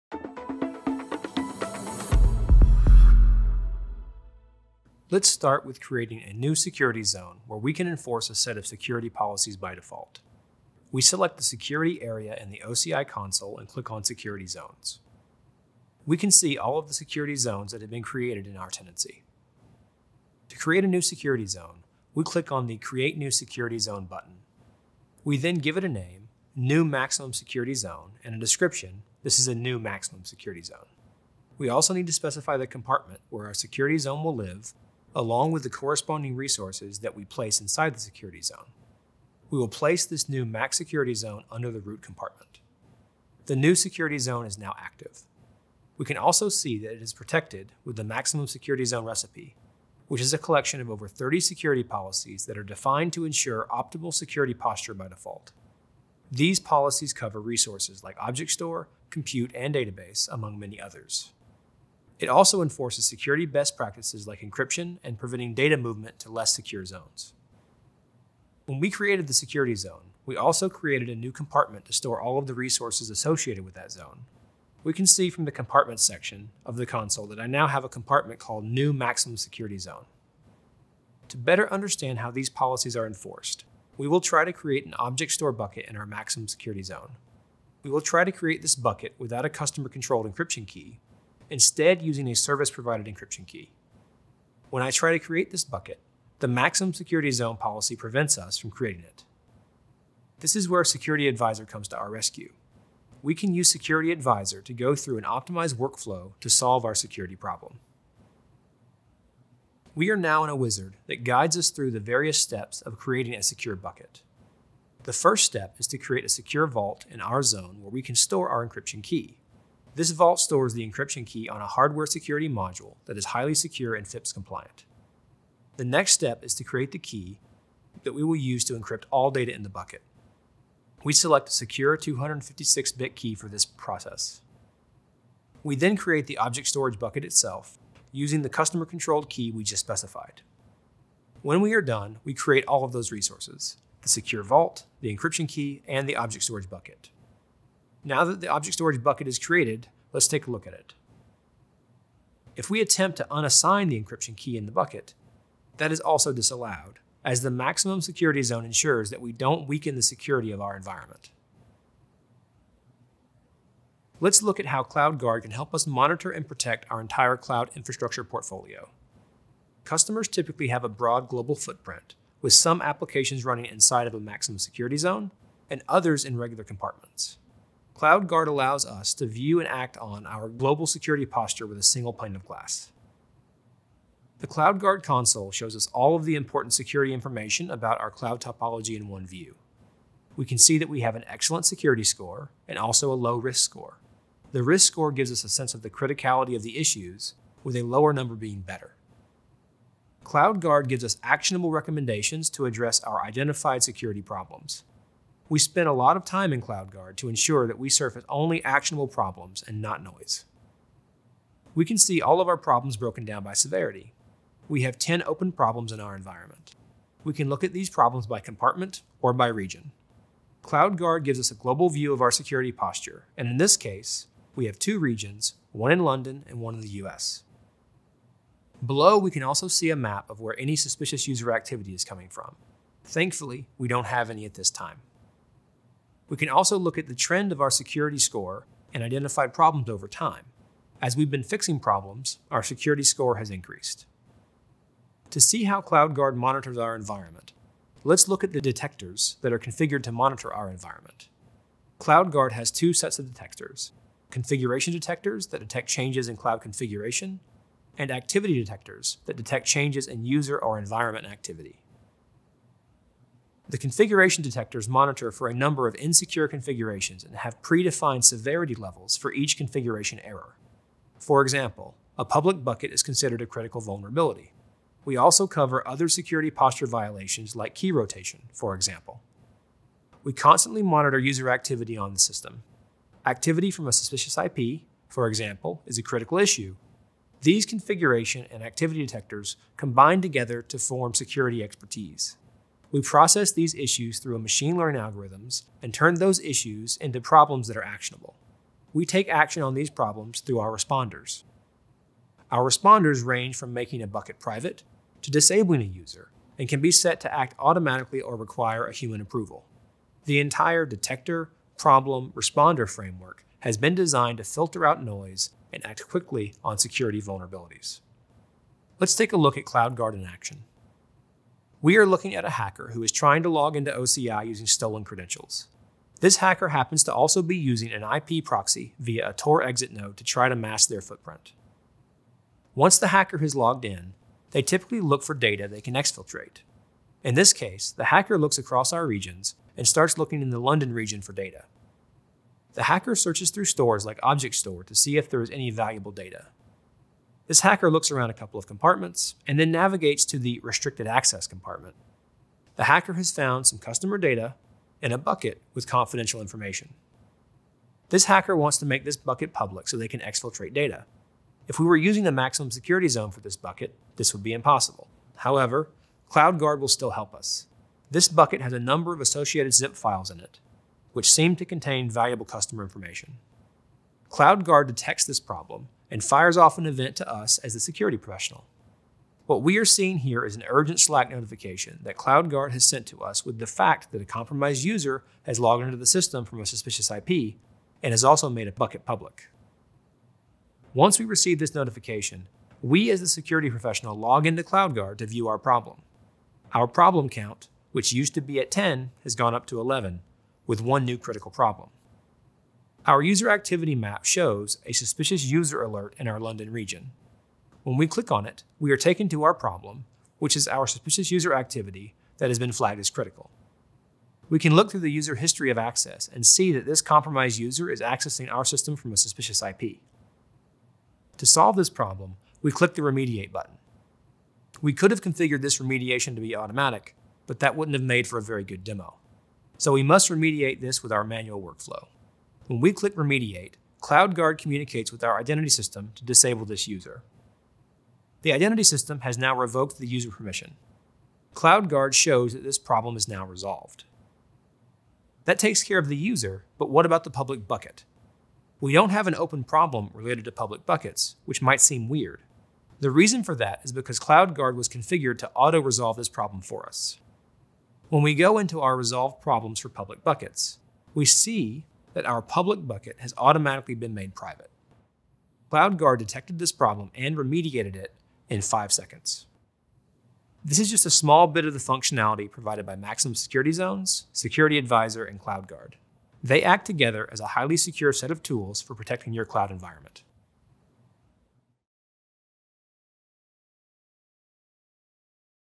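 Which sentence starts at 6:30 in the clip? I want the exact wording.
Once we receive this notification, we as the security professional log into CloudGuard to view our problem.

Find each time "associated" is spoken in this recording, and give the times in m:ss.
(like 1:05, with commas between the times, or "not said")
1:13, 6:09.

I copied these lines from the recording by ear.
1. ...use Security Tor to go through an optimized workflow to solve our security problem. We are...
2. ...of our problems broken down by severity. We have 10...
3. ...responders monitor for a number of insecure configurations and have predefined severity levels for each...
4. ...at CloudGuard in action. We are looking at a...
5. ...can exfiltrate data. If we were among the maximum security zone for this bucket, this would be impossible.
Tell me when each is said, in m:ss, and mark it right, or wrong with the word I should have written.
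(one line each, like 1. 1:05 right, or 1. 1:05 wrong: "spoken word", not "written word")
1. 1:43 wrong: "Advisor", not "Tor"
2. 3:32 right
3. 4:24 wrong: "detectors", not "responders"
4. 5:19 right
5. 6:00 wrong: "using", not "among".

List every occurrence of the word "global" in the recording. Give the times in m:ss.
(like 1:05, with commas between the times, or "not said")
2:51, 3:00, 3:41.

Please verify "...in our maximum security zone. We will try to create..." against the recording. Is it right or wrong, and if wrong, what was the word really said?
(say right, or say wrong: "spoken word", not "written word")
right.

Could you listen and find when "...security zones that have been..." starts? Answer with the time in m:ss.
0:16.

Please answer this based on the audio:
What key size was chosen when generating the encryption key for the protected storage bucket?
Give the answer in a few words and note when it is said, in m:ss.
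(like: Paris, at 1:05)
256-bit, at 2:11.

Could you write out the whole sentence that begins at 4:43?
Activity from a suspicious IP, for example, is a critical issue.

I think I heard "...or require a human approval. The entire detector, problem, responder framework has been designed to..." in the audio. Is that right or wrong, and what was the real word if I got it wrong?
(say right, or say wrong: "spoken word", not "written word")
right.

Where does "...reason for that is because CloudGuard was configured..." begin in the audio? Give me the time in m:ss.
7:33.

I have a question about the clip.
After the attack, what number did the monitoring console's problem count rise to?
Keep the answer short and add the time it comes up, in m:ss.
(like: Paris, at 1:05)
11, at 6:39.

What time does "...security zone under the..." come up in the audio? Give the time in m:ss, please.
0:40.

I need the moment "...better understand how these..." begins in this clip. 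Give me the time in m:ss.
1:21.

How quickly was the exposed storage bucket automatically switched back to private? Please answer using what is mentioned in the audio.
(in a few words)
5 seconds.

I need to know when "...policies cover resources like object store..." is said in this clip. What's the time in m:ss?
0:56.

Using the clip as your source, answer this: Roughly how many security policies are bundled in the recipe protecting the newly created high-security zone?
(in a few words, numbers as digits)
over 30.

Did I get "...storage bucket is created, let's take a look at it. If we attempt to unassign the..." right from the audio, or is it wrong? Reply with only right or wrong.
right.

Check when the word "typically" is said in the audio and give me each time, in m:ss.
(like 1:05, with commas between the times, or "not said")
2:50, 5:34.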